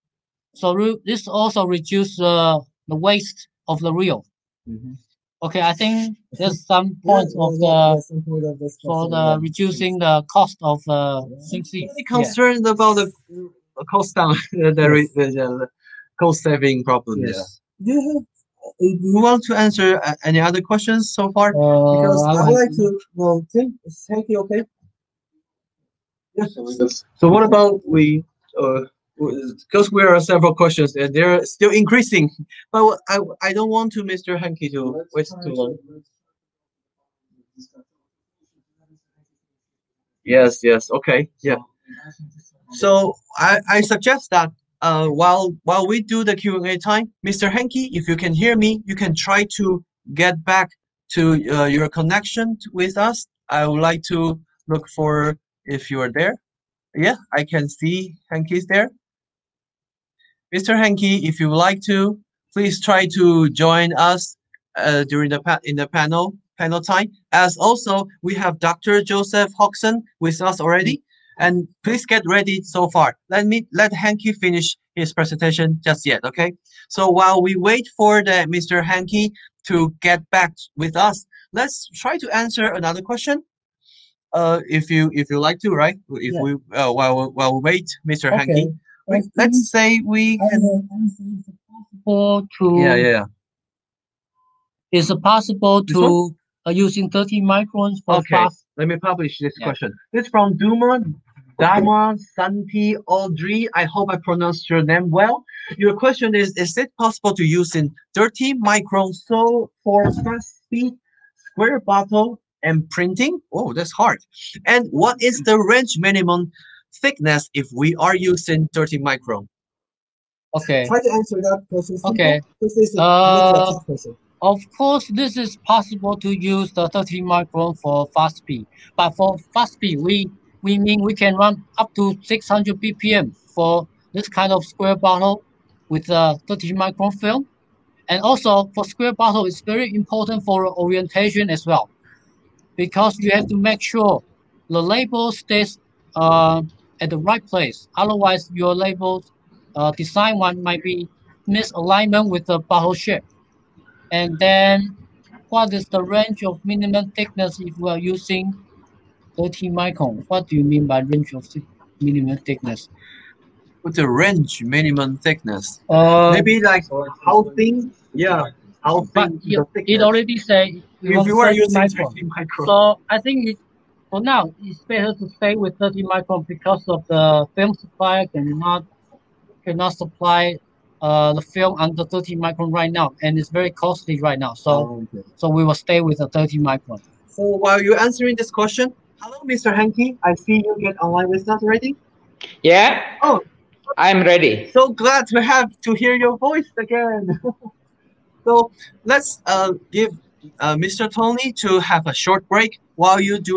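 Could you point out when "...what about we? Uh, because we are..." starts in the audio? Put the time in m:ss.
0:27.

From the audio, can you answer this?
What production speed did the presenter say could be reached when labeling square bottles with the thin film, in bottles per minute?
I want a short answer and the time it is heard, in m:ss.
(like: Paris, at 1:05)
600 BPM, at 2:12.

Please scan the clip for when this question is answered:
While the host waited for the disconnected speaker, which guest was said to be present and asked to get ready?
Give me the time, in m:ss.
1:08.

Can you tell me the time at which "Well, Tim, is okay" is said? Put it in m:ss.
0:23.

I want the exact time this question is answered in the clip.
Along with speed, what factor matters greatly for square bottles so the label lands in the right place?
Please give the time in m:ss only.
2:20.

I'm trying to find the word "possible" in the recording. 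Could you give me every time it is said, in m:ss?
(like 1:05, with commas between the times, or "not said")
1:35, 1:46, 2:05.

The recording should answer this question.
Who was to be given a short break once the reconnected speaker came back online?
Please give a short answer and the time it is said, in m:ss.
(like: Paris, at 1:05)
Mr. Tony, at 3:20.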